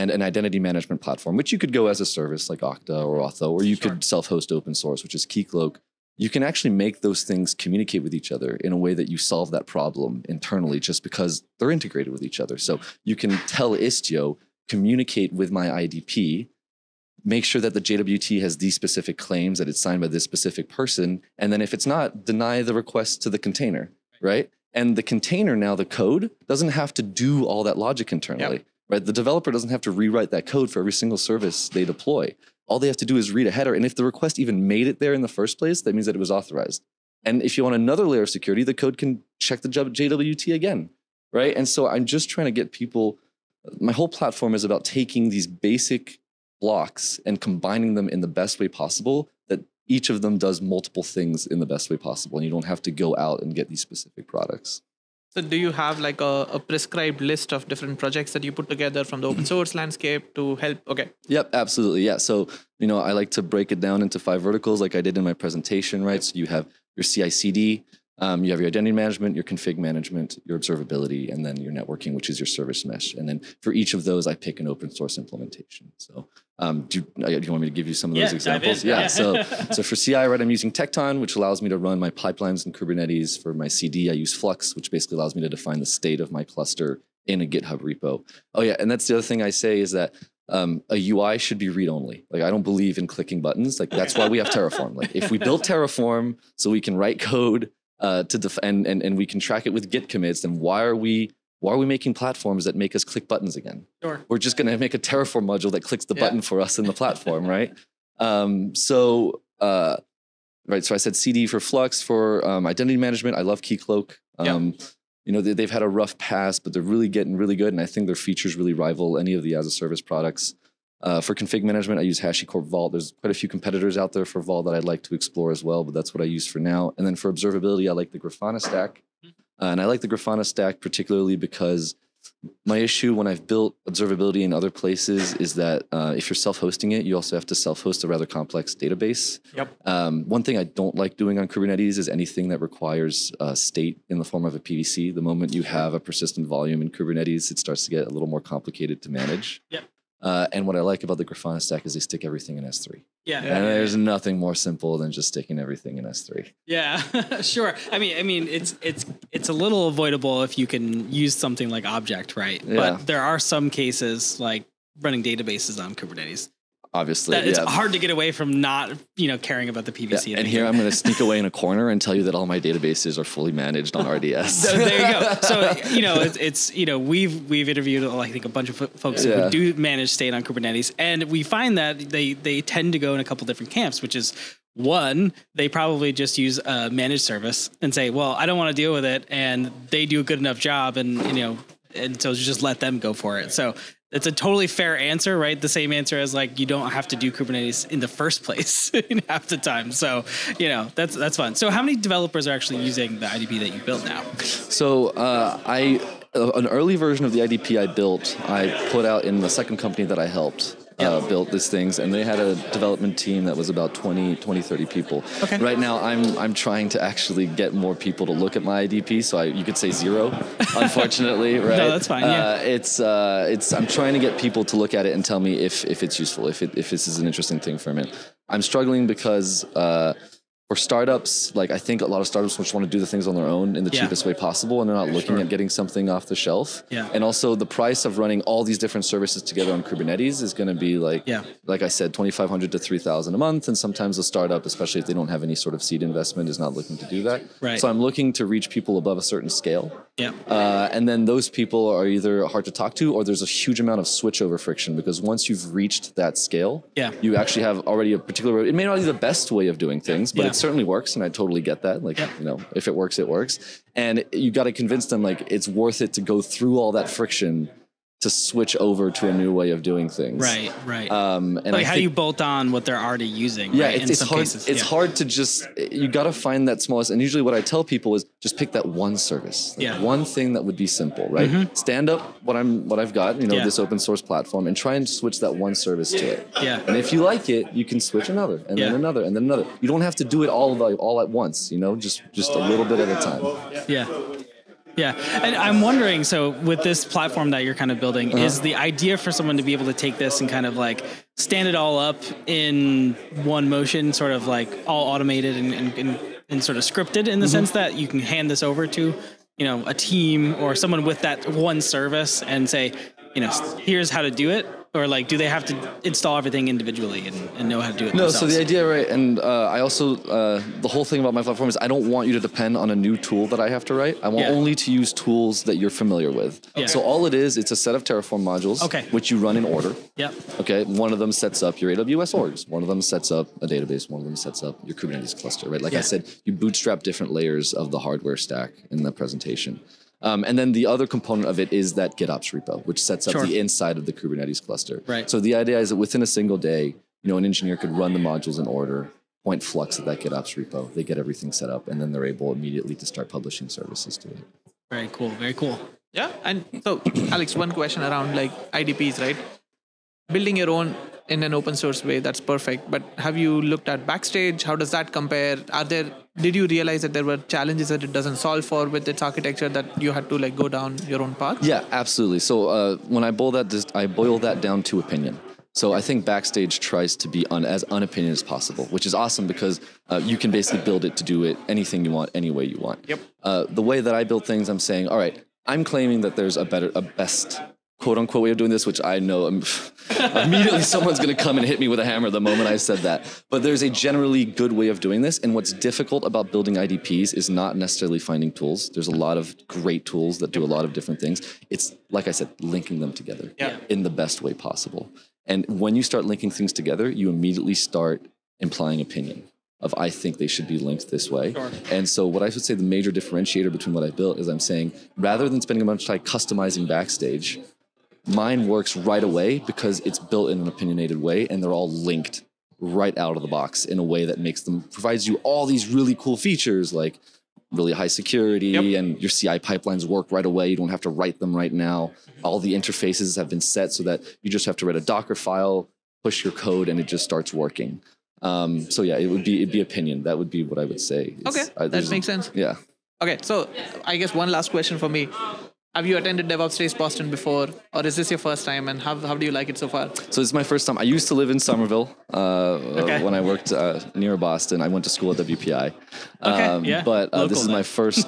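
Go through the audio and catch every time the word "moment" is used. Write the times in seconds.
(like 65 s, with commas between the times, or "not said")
145 s, 392 s.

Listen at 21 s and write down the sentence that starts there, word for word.
And then if it's not, deny the request to the container, right?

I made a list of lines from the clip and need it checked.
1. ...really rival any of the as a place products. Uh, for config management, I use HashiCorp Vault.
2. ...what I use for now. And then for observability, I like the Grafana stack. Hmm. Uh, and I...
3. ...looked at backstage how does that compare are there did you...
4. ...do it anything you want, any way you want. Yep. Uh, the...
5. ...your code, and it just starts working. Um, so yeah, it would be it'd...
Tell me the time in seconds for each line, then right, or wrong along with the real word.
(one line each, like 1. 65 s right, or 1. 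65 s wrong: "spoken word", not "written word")
1. 118 s wrong: "service", not "place"
2. 126 s right
3. 363 s right
4. 381 s right
5. 436 s right.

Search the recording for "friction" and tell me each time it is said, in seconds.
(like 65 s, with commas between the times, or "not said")
254 s, 267 s.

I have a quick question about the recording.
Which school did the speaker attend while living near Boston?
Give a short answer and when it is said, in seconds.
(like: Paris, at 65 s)
WPI, at 455 s.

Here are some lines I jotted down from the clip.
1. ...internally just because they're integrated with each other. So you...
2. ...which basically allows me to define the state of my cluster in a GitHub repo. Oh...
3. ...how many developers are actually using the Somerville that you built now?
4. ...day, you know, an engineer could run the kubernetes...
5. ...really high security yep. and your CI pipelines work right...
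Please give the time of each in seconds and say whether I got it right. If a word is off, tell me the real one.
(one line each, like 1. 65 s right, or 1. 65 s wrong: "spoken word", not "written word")
1. 10 s right
2. 84 s right
3. 201 s wrong: "IDP", not "Somerville"
4. 346 s wrong: "modules", not "kubernetes"
5. 427 s right.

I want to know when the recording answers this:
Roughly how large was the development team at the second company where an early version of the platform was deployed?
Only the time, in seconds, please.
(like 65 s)
214 s.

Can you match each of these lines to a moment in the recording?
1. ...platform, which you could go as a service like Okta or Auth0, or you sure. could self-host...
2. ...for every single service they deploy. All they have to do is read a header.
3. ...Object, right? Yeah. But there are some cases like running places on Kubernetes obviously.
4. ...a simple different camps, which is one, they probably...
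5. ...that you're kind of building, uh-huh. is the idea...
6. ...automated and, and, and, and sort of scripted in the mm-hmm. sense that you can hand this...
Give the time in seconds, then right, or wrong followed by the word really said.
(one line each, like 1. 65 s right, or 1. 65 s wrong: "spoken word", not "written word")
1. 0 s right
2. 30 s right
3. 161 s wrong: "databases", not "places"
4. 183 s wrong: "couple", not "simple"
5. 297 s right
6. 305 s right.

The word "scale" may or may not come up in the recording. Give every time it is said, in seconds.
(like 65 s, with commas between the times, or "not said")
249 s, 256 s.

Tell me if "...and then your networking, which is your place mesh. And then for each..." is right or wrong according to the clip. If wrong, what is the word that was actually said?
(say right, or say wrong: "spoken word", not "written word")
wrong: "service", not "place".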